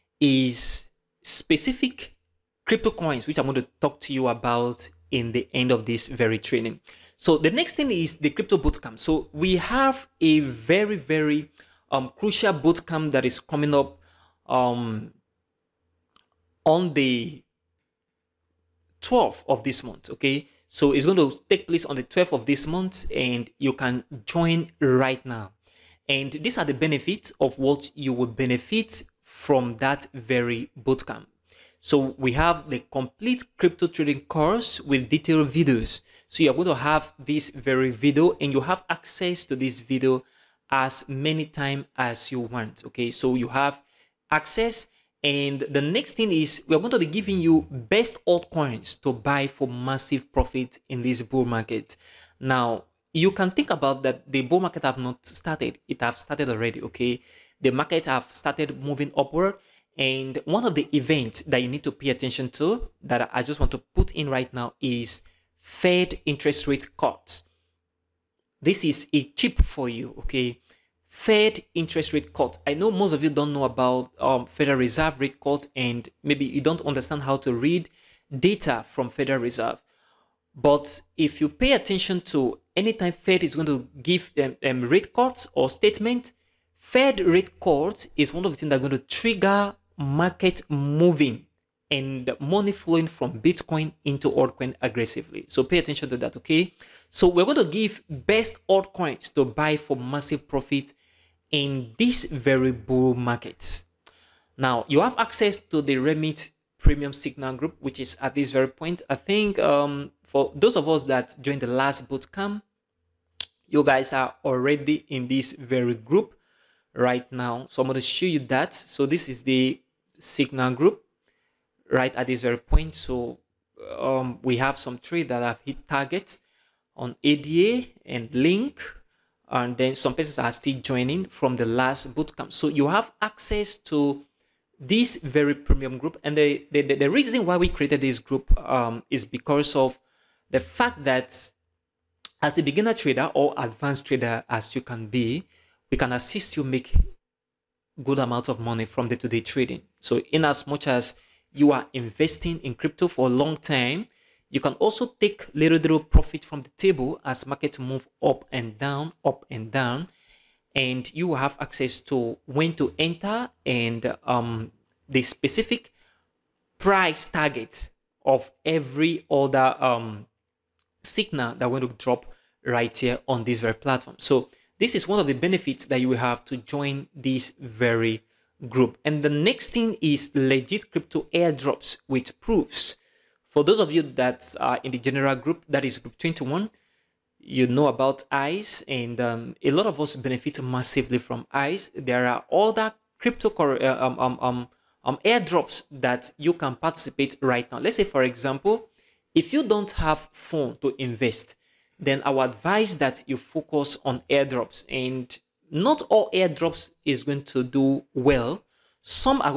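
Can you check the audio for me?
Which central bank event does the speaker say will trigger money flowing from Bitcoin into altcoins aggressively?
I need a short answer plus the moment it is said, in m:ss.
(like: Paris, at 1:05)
Fed interest rate cuts, at 1:05.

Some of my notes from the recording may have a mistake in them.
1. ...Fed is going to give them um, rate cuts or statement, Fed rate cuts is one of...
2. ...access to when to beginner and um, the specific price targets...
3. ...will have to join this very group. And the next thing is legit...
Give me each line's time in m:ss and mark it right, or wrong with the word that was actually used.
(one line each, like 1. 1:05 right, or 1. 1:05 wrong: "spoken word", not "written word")
1. 1:23 right
2. 2:41 wrong: "enter", not "beginner"
3. 2:56 right.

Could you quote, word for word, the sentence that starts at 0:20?
Okay, so it's going to take place on the 12th of this month, and you can join right now.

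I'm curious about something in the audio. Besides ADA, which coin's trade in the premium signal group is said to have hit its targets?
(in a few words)
Link.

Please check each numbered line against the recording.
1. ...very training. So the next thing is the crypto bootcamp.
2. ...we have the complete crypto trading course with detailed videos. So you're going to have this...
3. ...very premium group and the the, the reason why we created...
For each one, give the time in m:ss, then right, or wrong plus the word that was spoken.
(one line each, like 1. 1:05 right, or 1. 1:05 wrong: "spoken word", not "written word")
1. 0:06 right
2. 0:32 right
3. 2:15 right.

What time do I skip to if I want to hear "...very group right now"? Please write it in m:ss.
1:55.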